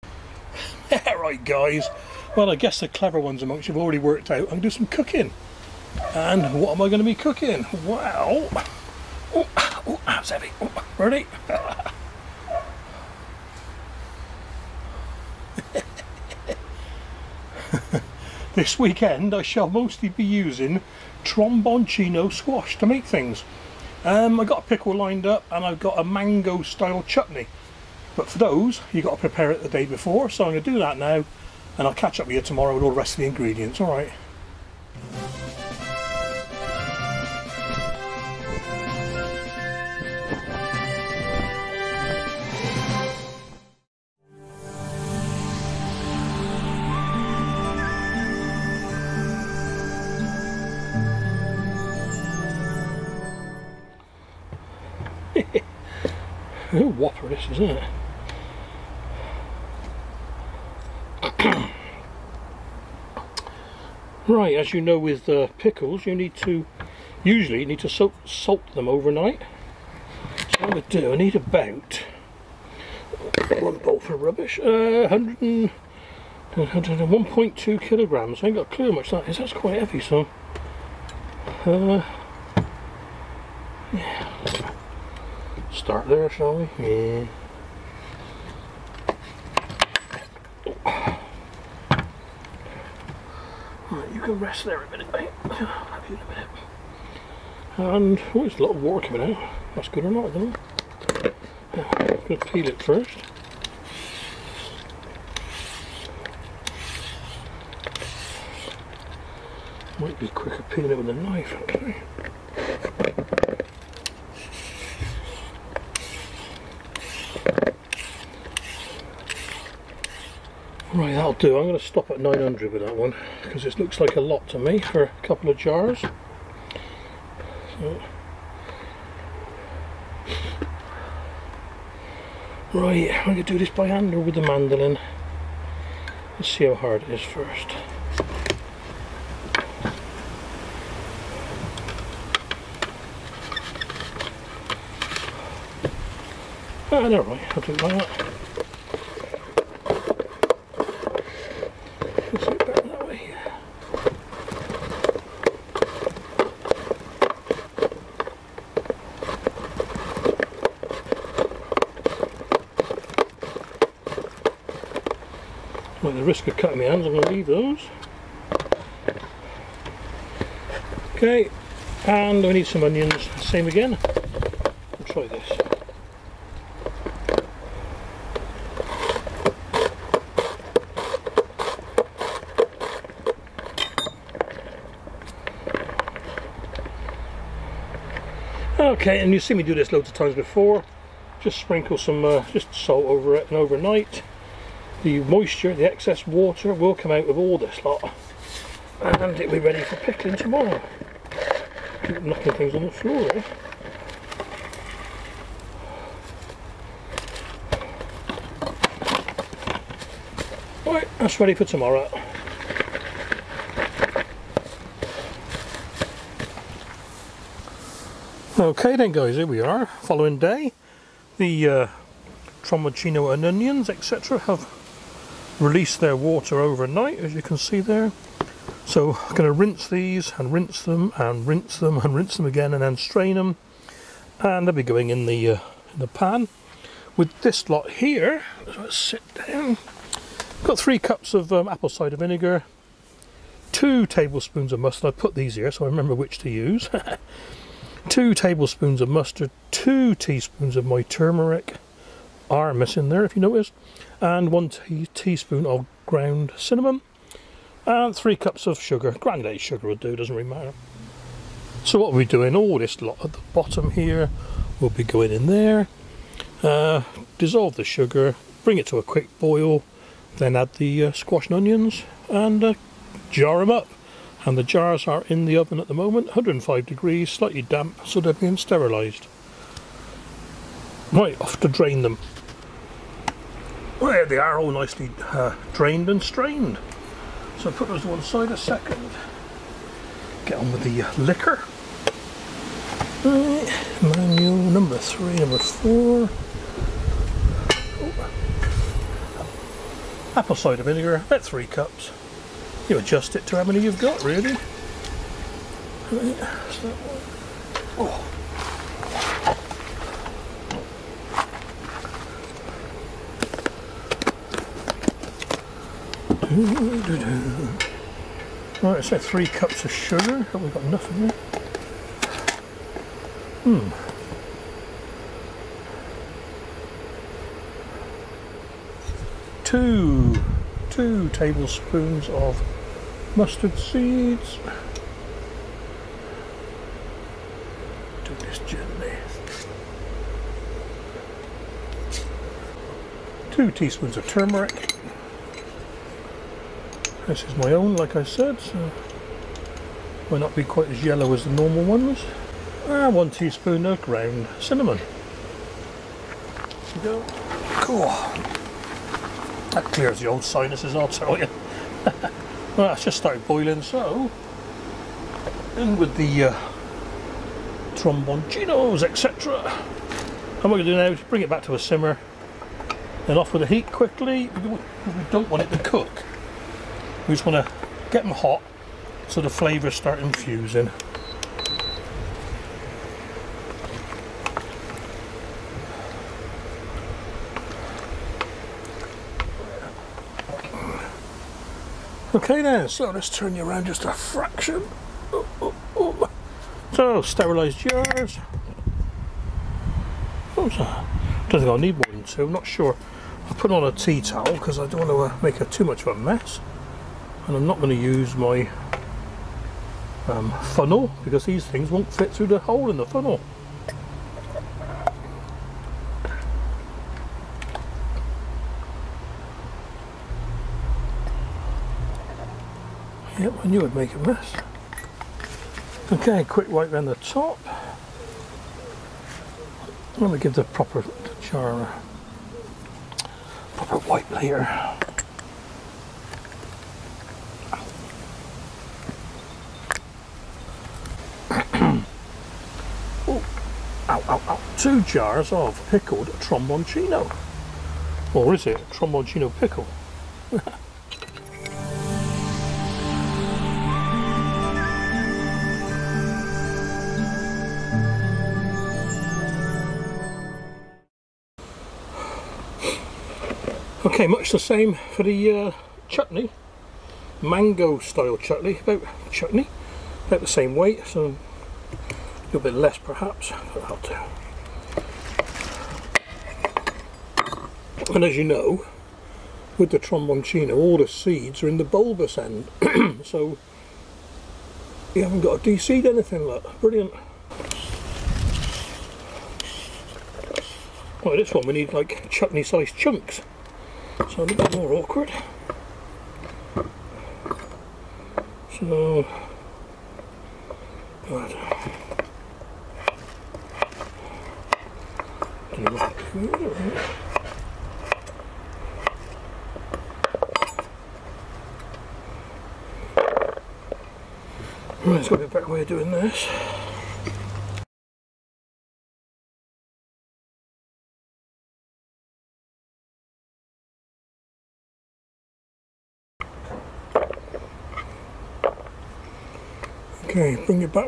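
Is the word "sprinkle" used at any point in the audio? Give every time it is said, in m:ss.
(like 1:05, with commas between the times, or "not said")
3:11.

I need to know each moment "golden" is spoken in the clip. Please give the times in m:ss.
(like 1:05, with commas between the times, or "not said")
not said.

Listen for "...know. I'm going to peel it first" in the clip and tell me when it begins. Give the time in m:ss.
1:40.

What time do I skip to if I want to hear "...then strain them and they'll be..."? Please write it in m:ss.
3:52.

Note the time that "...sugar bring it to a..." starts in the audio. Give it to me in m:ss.
4:27.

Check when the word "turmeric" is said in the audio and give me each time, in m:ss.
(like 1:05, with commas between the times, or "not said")
4:11, 5:44.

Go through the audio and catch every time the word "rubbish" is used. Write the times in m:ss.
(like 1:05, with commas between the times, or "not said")
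1:14.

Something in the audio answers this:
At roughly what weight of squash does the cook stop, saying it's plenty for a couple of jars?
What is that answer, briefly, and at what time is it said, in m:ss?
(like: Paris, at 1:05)
900, at 2:02.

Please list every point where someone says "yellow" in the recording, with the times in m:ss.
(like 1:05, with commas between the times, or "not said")
5:51.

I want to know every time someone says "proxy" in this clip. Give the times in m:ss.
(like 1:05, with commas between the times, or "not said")
not said.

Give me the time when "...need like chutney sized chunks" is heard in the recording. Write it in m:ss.
8:11.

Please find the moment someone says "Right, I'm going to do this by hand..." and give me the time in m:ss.
2:12.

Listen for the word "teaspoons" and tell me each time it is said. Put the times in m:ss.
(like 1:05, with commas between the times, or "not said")
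4:10, 4:15, 5:43, 5:53.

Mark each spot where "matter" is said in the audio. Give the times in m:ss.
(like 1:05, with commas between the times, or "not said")
4:20.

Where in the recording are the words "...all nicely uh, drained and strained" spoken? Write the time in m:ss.
4:44.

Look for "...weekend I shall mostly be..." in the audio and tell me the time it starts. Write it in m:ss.
0:18.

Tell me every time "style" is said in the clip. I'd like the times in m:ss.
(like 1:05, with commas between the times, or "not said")
0:26, 7:47.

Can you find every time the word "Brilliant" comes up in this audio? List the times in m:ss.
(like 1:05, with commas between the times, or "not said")
8:06.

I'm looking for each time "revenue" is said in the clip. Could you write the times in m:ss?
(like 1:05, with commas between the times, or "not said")
not said.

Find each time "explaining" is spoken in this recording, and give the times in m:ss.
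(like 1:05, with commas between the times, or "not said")
not said.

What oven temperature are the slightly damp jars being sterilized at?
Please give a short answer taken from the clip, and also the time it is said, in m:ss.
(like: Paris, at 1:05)
105 degrees, at 4:36.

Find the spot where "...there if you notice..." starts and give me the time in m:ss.
4:13.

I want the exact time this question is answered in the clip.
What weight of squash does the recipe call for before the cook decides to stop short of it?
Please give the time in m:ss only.
1:16.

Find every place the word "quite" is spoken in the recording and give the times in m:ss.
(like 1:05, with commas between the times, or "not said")
1:19, 5:50.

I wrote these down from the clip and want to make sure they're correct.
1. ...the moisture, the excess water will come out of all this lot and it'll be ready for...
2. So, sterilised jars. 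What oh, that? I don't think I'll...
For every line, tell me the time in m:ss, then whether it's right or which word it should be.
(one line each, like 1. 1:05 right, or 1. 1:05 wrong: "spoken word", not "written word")
1. 3:15 right
2. 6:36 right.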